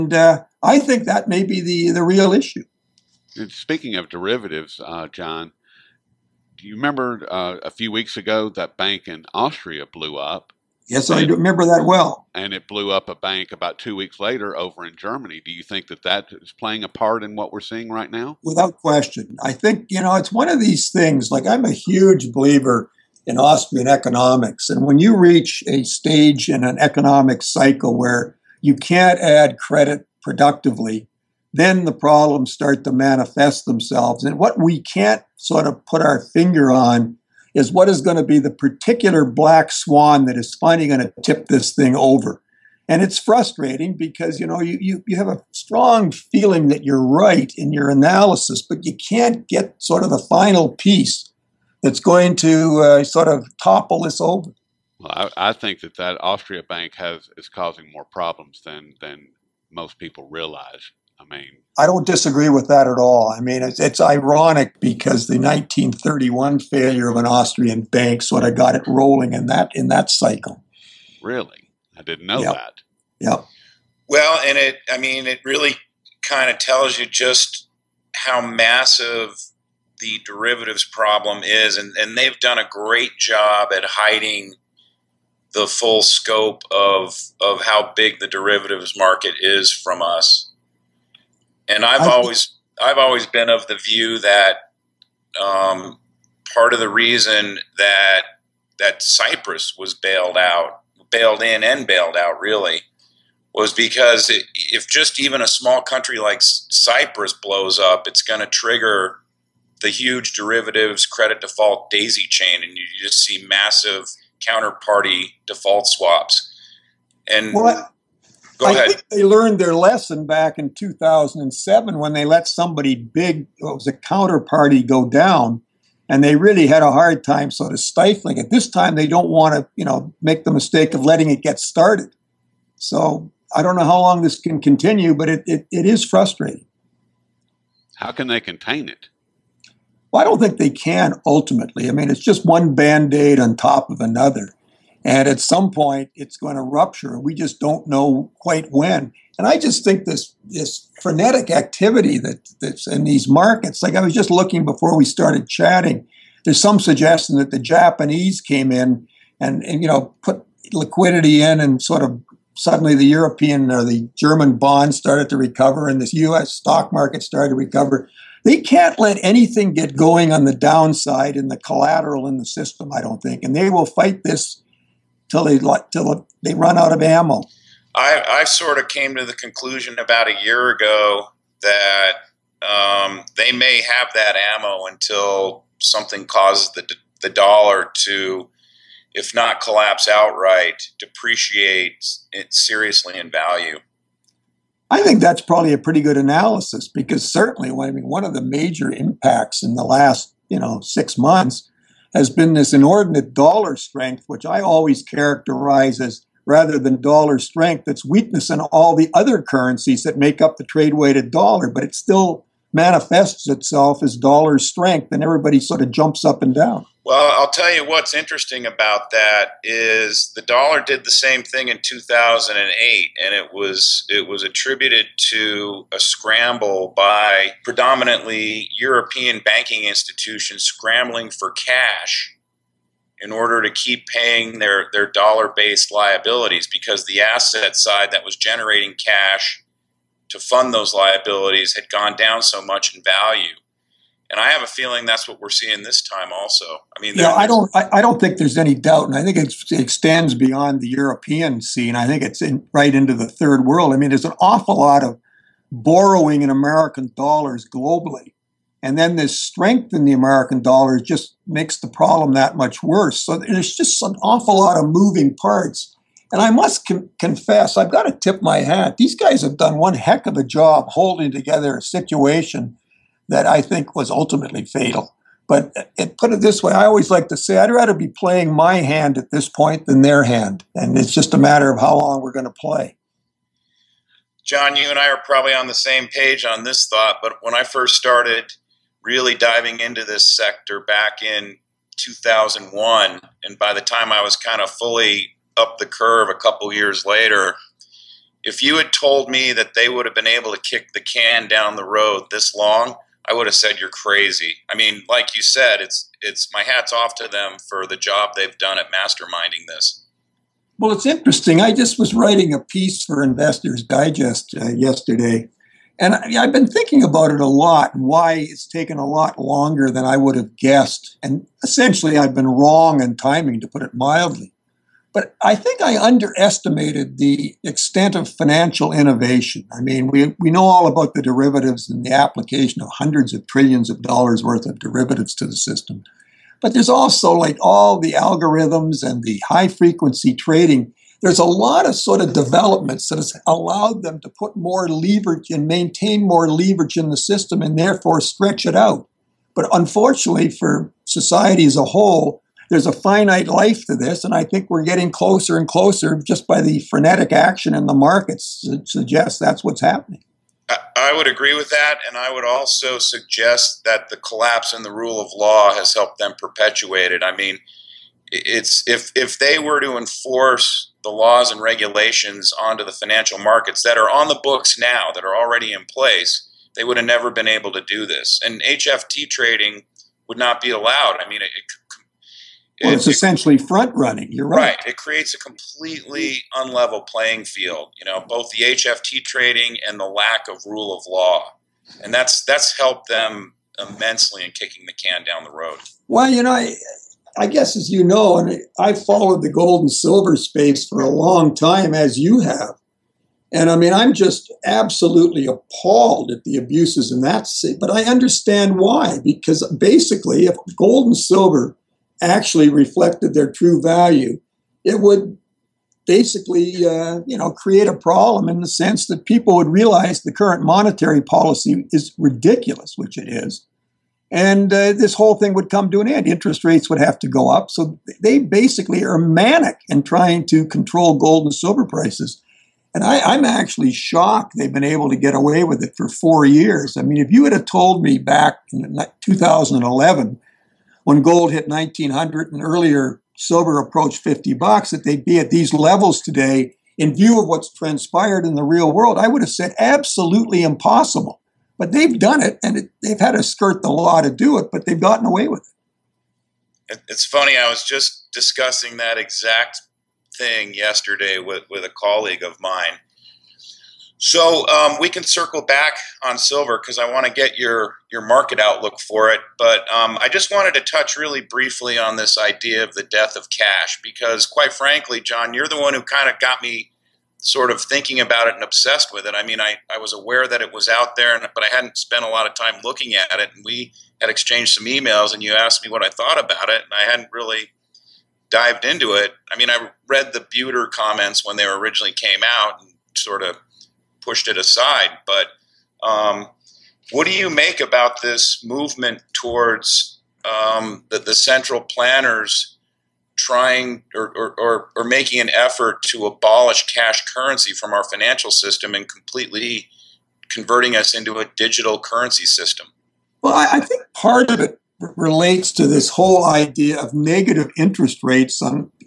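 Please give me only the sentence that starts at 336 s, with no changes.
But there's also like all the algorithms and the high frequency trading.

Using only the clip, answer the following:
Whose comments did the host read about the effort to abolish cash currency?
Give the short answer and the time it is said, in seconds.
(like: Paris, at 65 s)
Buiter, at 490 s.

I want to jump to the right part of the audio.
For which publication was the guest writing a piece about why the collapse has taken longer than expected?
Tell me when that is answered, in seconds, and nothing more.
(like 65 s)
313 s.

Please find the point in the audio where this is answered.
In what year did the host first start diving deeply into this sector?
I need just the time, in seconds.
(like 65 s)
291 s.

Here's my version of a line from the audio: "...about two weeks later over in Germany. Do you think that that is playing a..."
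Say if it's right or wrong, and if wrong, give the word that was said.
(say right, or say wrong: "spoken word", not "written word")
right.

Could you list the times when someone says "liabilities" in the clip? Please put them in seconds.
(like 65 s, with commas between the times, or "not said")
235 s, 240 s.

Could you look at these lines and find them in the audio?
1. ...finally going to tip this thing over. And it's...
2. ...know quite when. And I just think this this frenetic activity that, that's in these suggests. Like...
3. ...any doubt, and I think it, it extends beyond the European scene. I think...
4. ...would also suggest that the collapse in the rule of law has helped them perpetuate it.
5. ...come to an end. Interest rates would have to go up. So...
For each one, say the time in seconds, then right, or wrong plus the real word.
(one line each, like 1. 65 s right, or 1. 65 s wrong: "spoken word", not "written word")
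1. 40 s right
2. 147 s wrong: "markets", not "suggests"
3. 248 s right
4. 362 s right
5. 425 s right.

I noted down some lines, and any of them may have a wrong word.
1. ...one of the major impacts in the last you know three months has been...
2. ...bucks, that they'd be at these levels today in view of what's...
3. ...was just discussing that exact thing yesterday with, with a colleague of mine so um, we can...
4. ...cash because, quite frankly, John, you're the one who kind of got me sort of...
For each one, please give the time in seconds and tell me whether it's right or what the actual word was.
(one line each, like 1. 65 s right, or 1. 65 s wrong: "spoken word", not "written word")
1. 198 s wrong: "six", not "three"
2. 444 s right
3. 457 s right
4. 473 s right.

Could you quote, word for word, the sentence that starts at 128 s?
This time they don't want to, you know, make the mistake of letting it get started.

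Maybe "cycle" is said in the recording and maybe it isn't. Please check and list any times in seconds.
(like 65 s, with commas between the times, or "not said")
27 s, 70 s.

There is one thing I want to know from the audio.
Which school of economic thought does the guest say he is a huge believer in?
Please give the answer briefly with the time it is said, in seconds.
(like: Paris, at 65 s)
Austrian economics, at 23 s.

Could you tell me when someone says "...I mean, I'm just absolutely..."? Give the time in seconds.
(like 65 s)
403 s.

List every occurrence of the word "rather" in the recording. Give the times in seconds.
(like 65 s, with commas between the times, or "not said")
206 s, 277 s.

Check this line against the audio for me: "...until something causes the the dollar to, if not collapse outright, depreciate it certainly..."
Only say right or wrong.
wrong.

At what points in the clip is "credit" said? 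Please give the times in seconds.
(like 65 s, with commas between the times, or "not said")
29 s, 111 s.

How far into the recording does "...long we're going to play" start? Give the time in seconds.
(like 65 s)
281 s.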